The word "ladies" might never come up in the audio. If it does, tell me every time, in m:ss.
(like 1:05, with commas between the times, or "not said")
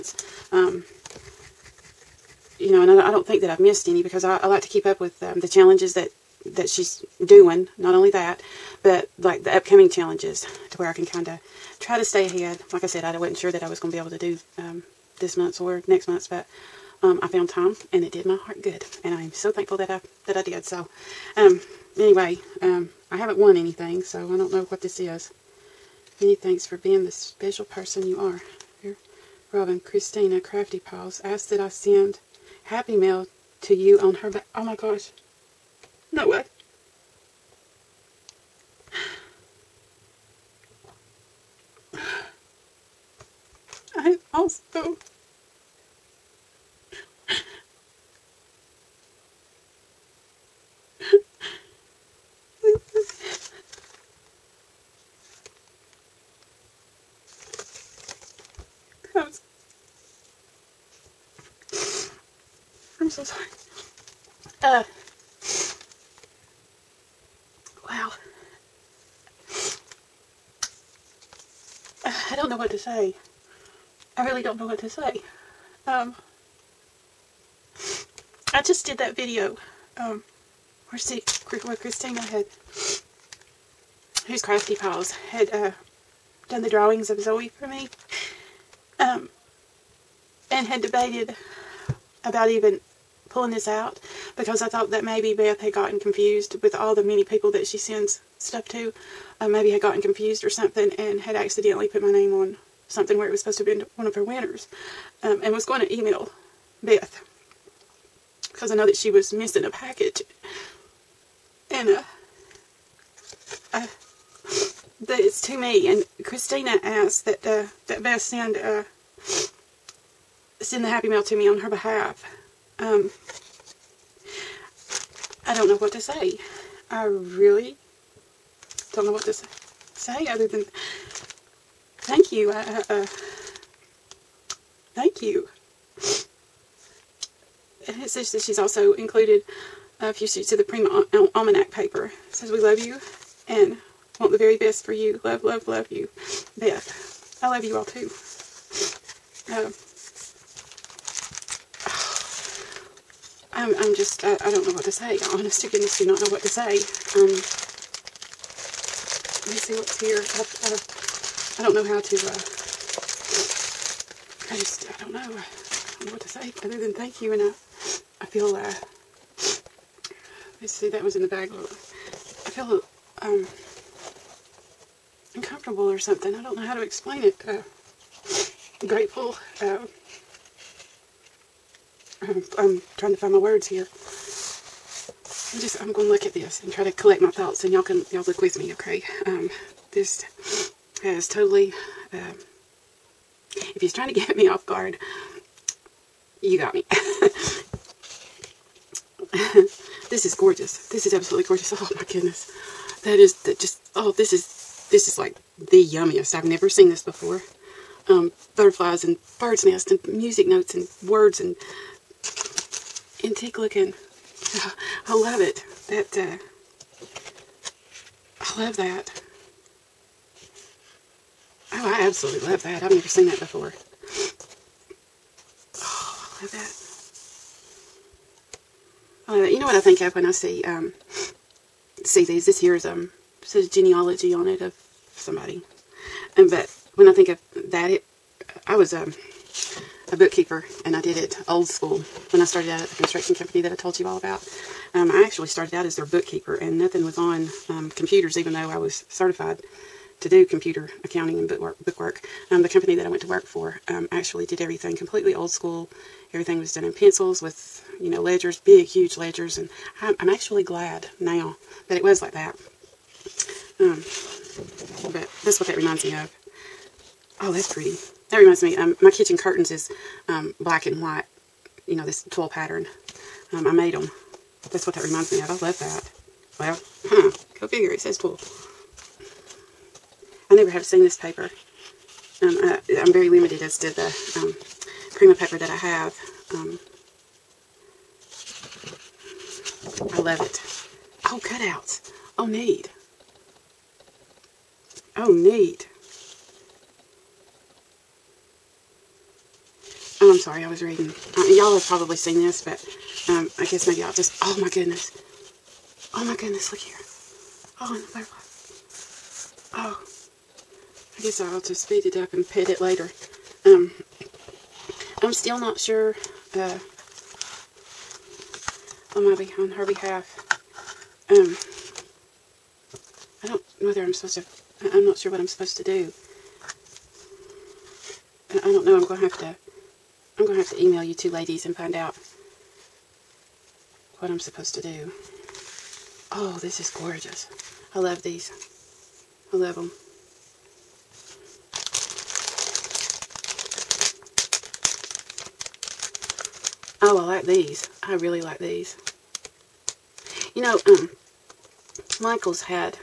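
5:31.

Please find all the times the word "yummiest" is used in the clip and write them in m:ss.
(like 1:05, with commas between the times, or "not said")
3:25.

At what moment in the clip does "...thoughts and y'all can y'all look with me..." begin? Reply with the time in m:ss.
3:07.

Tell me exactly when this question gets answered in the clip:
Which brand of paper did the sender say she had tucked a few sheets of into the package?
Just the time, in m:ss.
2:20.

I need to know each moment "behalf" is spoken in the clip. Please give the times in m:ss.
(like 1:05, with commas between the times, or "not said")
2:01, 5:19.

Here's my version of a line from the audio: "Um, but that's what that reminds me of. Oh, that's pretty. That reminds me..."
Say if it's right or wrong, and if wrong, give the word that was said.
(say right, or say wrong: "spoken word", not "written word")
right.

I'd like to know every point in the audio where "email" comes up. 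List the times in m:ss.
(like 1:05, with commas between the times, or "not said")
1:45, 5:30.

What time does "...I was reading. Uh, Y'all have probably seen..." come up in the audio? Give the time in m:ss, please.
5:00.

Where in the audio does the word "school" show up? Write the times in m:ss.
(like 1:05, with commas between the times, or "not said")
4:01, 4:15.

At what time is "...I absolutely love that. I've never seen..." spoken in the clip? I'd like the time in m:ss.
3:41.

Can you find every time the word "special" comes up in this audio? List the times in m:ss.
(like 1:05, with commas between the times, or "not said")
0:27.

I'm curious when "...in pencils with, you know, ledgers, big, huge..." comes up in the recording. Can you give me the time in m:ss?
4:16.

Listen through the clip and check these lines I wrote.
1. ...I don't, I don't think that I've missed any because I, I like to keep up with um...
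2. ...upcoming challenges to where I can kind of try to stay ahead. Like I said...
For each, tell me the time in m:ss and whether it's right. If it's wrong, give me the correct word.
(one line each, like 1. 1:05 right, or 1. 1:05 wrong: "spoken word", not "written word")
1. 0:02 right
2. 0:09 right.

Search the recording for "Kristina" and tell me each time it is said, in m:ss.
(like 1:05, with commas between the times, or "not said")
0:29, 1:21, 1:56.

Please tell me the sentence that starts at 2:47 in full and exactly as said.
And I, uh, I feel, uh, let's see, that was in the bag.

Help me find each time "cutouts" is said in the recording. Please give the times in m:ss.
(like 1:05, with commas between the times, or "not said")
4:51.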